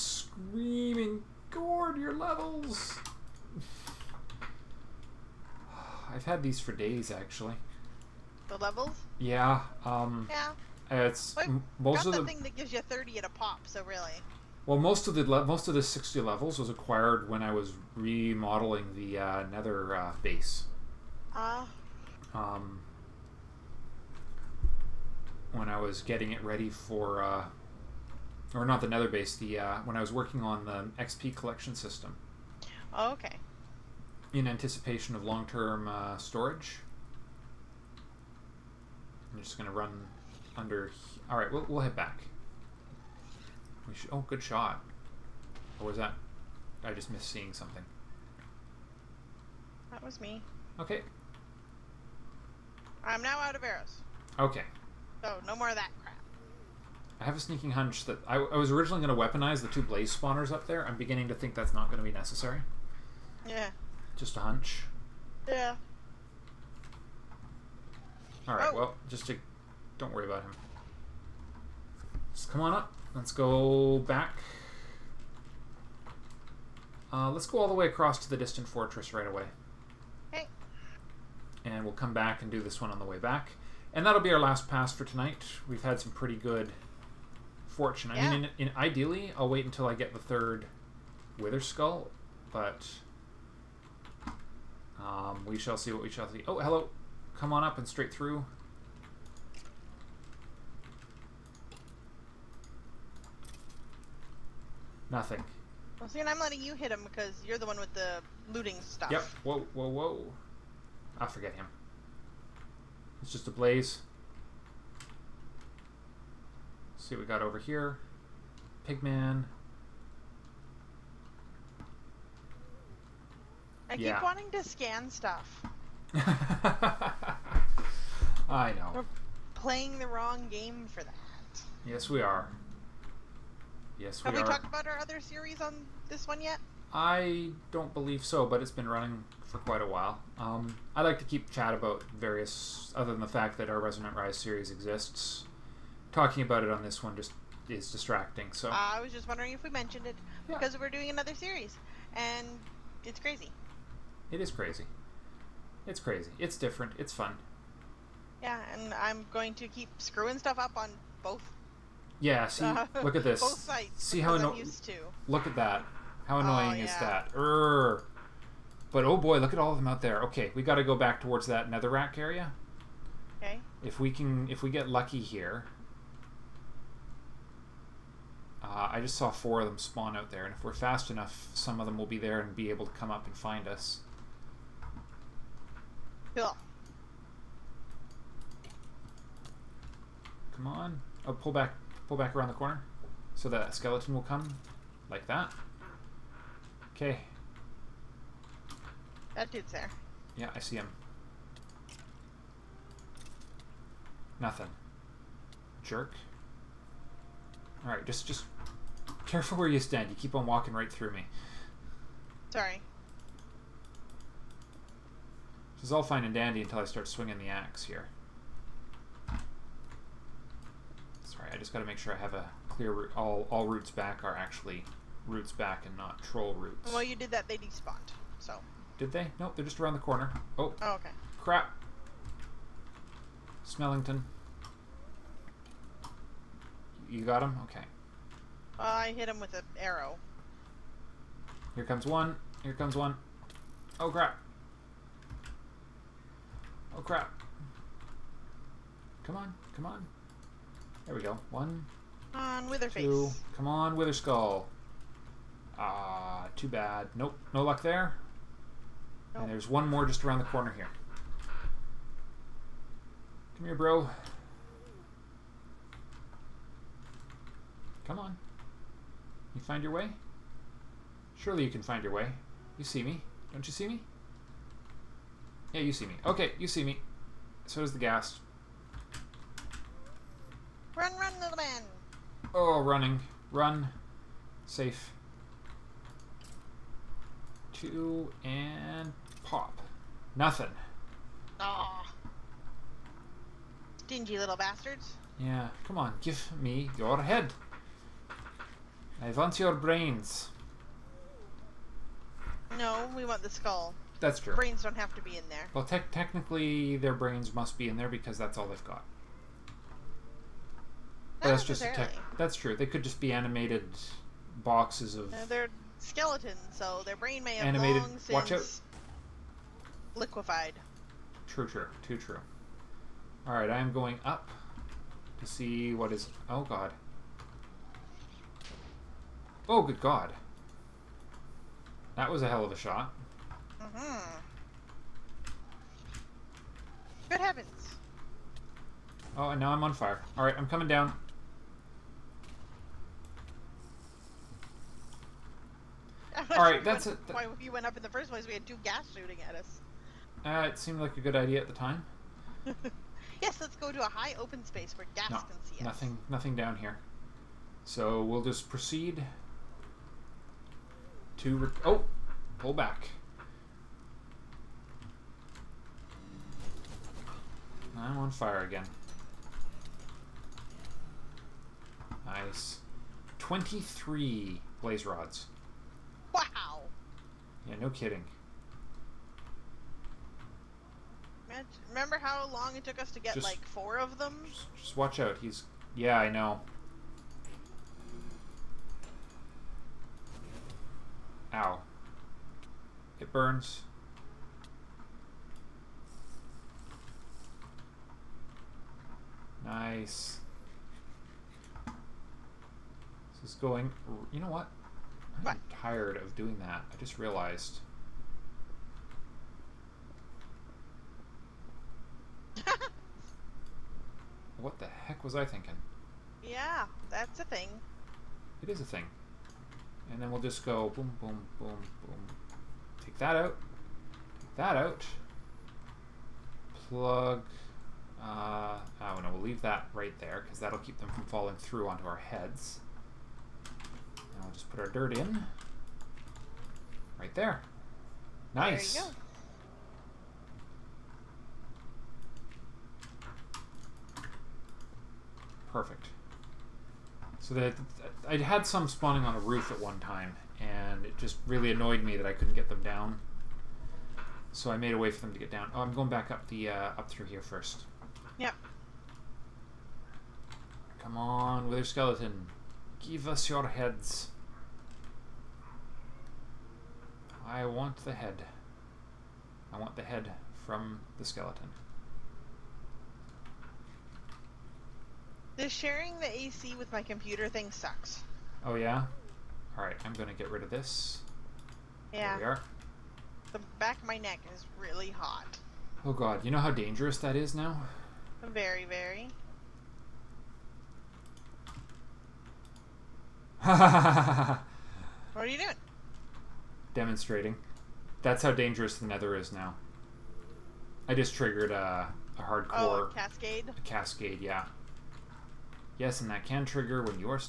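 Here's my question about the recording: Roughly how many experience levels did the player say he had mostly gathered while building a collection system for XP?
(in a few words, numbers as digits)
60.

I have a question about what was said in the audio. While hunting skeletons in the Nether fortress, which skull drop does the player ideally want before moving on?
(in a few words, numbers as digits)
third.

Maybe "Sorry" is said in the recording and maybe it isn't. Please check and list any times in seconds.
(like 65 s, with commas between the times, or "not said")
212 s, 221 s.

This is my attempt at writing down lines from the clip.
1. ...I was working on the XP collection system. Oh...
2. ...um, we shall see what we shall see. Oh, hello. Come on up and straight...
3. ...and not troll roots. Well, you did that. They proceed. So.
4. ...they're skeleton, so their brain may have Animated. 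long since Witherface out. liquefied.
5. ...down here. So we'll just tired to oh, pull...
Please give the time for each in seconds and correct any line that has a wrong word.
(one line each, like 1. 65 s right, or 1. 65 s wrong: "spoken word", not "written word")
1. 29 s right
2. 95 s right
3. 225 s wrong: "despawned", not "proceed"
4. 315 s wrong: "Watch", not "Witherface"
5. 356 s wrong: "proceed", not "tired".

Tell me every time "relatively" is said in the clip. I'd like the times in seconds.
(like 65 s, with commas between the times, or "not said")
not said.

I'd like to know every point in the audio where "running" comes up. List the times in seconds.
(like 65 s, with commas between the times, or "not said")
138 s, 282 s.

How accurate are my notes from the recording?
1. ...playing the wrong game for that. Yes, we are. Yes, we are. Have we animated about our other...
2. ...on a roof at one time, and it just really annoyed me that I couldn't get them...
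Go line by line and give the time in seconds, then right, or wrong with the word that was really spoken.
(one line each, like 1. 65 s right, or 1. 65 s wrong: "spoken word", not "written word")
1. 129 s wrong: "talked", not "animated"
2. 449 s right.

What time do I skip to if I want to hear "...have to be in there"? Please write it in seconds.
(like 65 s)
304 s.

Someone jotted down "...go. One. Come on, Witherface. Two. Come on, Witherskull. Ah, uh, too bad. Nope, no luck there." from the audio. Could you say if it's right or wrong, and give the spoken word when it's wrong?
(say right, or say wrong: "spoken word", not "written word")
right.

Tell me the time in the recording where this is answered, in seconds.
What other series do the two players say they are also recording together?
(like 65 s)
143 s.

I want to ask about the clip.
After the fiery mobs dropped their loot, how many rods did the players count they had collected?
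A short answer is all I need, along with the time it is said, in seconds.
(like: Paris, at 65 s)
23, at 373 s.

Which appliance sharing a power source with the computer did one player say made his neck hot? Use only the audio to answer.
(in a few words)
AC.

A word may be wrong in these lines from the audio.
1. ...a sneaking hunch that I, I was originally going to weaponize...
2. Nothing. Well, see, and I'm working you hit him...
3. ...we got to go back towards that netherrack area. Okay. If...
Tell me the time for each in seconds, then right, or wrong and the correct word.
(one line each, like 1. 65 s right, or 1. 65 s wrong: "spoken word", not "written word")
1. 57 s right
2. 105 s wrong: "letting", not "working"
3. 170 s right.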